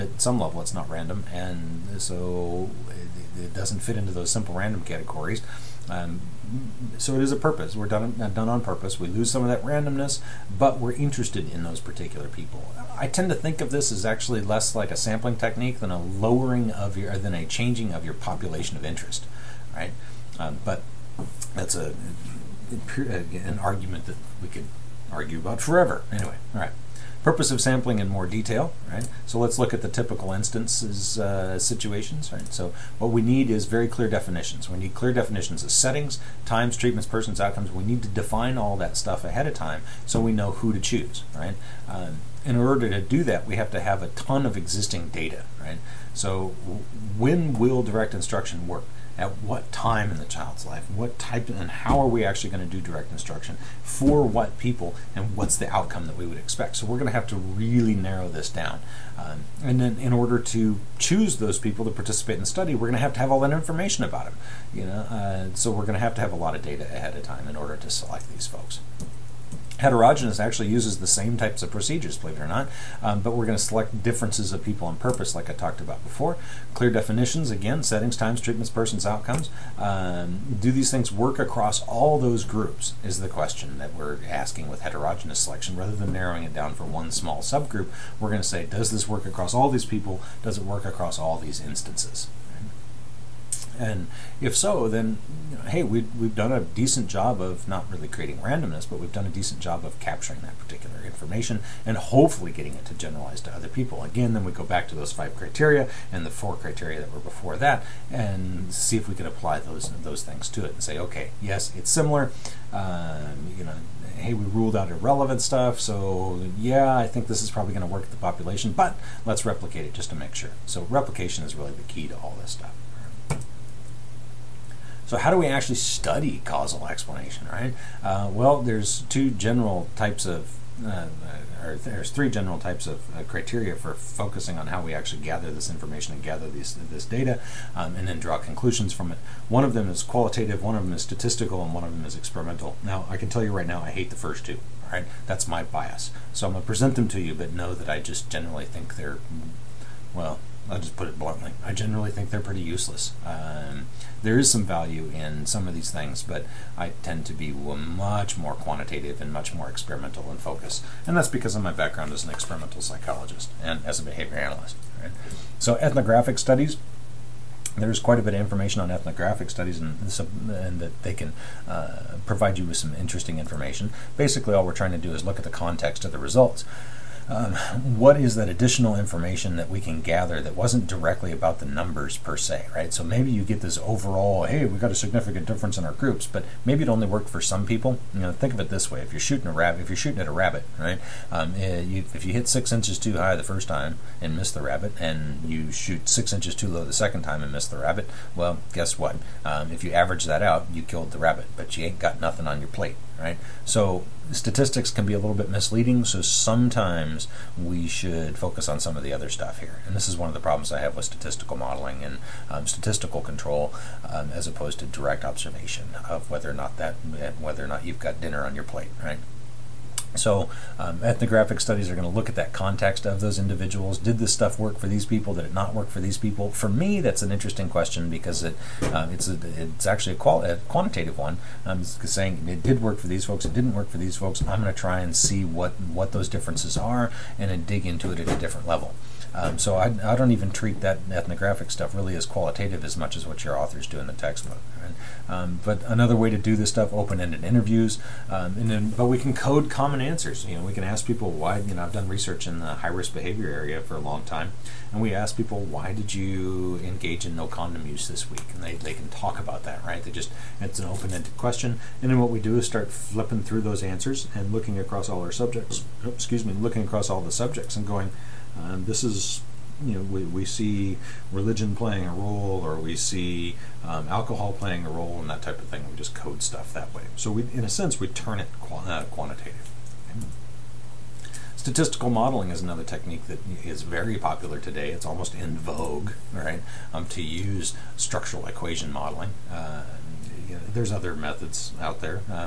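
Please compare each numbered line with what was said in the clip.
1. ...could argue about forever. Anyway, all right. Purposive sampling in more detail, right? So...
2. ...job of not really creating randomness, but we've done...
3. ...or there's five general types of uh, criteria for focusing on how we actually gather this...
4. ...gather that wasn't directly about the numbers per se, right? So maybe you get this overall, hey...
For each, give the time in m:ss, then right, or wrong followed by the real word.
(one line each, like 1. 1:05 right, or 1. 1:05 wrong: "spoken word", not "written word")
1. 0:24 right
2. 1:37 right
3. 2:11 wrong: "three", not "five"
4. 3:00 right.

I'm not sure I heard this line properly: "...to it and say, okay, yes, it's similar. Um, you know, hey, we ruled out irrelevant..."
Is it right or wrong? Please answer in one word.
right.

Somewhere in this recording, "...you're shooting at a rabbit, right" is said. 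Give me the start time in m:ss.
3:09.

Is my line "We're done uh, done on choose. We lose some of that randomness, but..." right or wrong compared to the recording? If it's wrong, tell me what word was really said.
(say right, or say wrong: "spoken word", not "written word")
wrong: "purpose", not "choose".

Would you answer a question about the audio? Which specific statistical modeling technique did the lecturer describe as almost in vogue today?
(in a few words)
structural equation modeling.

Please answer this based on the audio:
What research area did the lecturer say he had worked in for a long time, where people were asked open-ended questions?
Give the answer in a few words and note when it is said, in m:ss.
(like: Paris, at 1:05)
high-risk behavior, at 4:12.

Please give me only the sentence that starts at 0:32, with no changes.
So what we need is very clear definitions.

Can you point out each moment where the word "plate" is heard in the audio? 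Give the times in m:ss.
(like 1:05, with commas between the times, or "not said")
3:22, 3:38.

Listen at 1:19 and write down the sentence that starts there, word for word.
Um, do these things work across all those groups is the question that we're asking with heterogeneous selection.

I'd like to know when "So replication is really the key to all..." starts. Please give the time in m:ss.
2:00.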